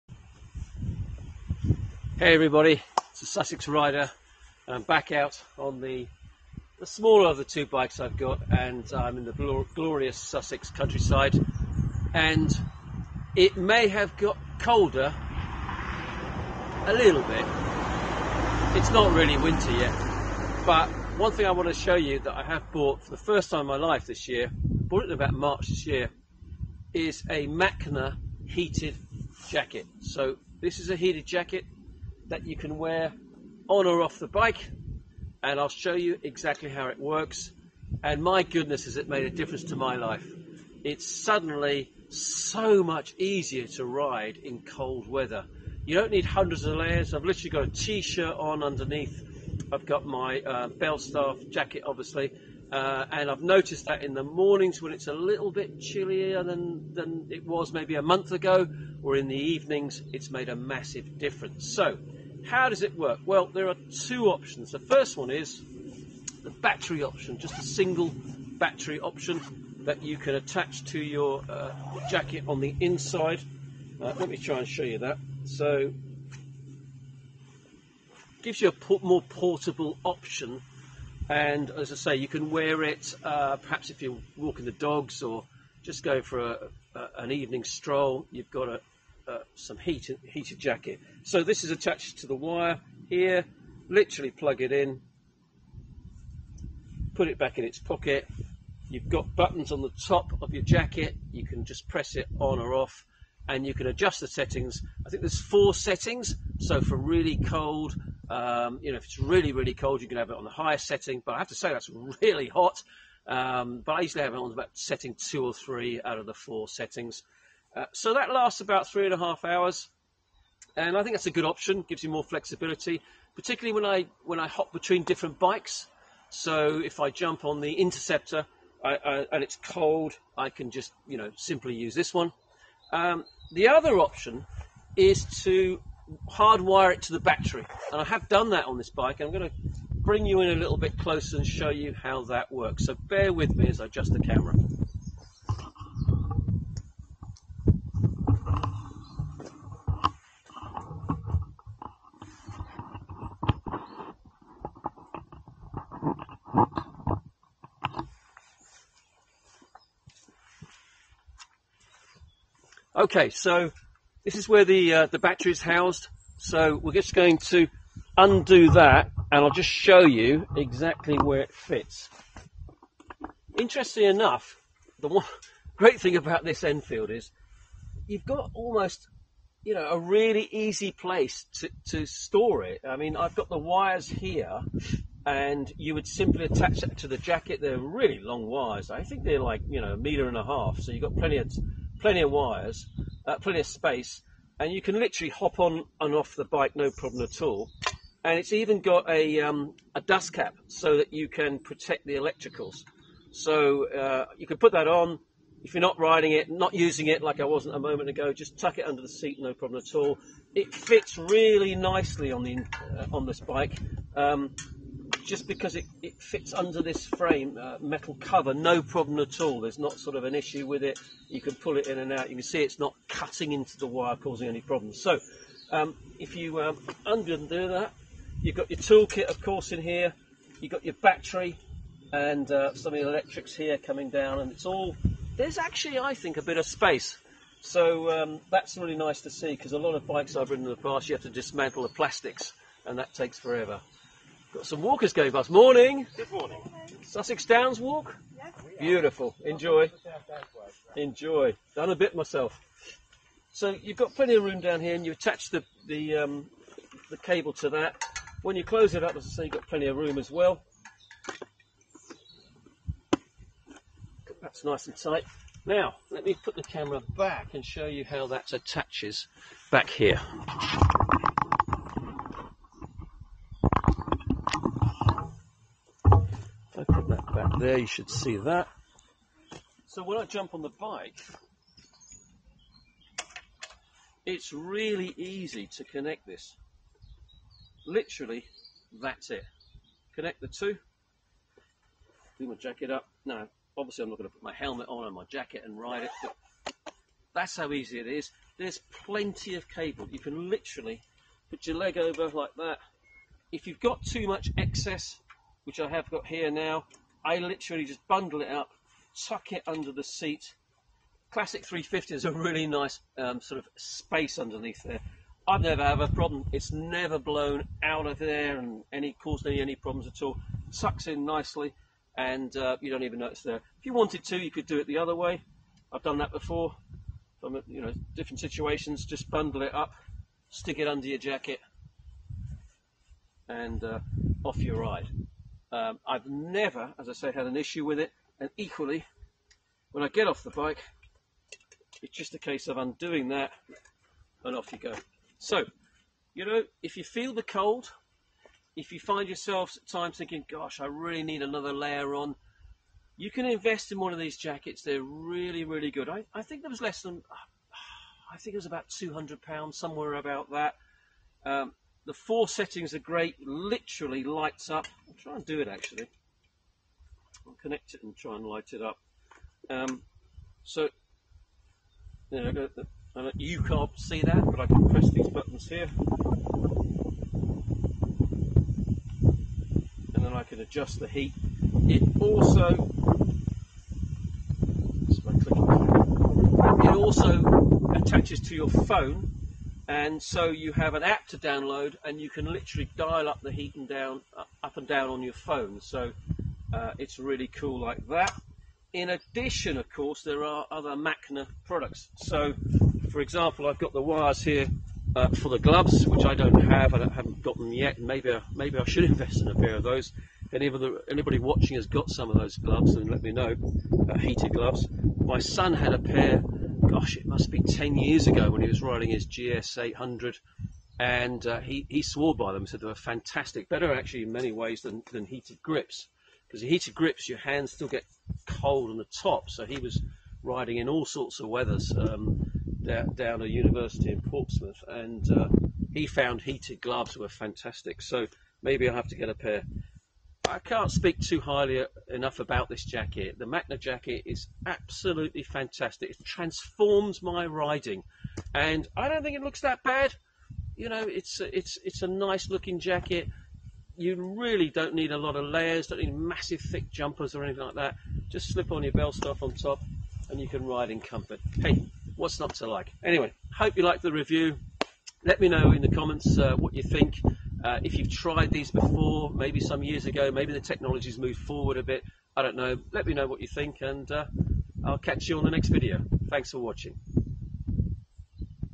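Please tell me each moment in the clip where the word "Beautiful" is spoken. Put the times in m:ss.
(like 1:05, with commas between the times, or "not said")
4:08.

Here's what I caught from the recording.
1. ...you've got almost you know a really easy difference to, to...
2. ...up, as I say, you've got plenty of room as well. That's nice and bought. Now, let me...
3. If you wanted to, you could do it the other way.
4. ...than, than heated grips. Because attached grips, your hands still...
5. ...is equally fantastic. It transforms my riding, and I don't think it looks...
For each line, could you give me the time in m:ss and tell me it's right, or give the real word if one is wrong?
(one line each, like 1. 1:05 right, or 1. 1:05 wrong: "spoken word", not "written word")
1. 2:58 wrong: "place", not "difference"
2. 4:19 wrong: "tight", not "bought"
3. 5:23 right
4. 7:04 wrong: "heated", not "attached"
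5. 7:24 wrong: "absolutely", not "equally".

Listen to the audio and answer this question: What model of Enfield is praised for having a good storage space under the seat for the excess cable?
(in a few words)
Classic 350.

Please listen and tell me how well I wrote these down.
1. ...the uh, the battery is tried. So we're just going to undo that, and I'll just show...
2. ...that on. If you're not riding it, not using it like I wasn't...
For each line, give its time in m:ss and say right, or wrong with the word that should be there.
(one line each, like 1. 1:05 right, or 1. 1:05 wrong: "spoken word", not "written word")
1. 2:44 wrong: "housed", not "tried"
2. 3:24 right.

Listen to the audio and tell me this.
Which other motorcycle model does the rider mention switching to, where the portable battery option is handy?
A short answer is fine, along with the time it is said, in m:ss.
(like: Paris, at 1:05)
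Interceptor, at 2:07.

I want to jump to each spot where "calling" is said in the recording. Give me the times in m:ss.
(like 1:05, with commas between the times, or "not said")
not said.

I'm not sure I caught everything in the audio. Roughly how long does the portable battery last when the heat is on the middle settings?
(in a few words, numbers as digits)
about three and a half hours.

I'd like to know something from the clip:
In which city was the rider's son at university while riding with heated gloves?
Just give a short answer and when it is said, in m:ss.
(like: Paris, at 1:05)
Portsmouth, at 7:14.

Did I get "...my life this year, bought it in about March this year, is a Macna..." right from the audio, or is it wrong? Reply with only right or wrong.
right.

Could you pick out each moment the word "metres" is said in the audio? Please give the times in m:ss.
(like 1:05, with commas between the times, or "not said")
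not said.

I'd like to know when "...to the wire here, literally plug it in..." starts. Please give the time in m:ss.
1:32.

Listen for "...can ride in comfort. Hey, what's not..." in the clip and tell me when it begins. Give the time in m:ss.
7:40.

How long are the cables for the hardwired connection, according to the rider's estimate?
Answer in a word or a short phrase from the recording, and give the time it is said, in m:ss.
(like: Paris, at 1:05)
a meter and a half, at 3:09.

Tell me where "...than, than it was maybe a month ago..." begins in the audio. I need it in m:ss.
0:56.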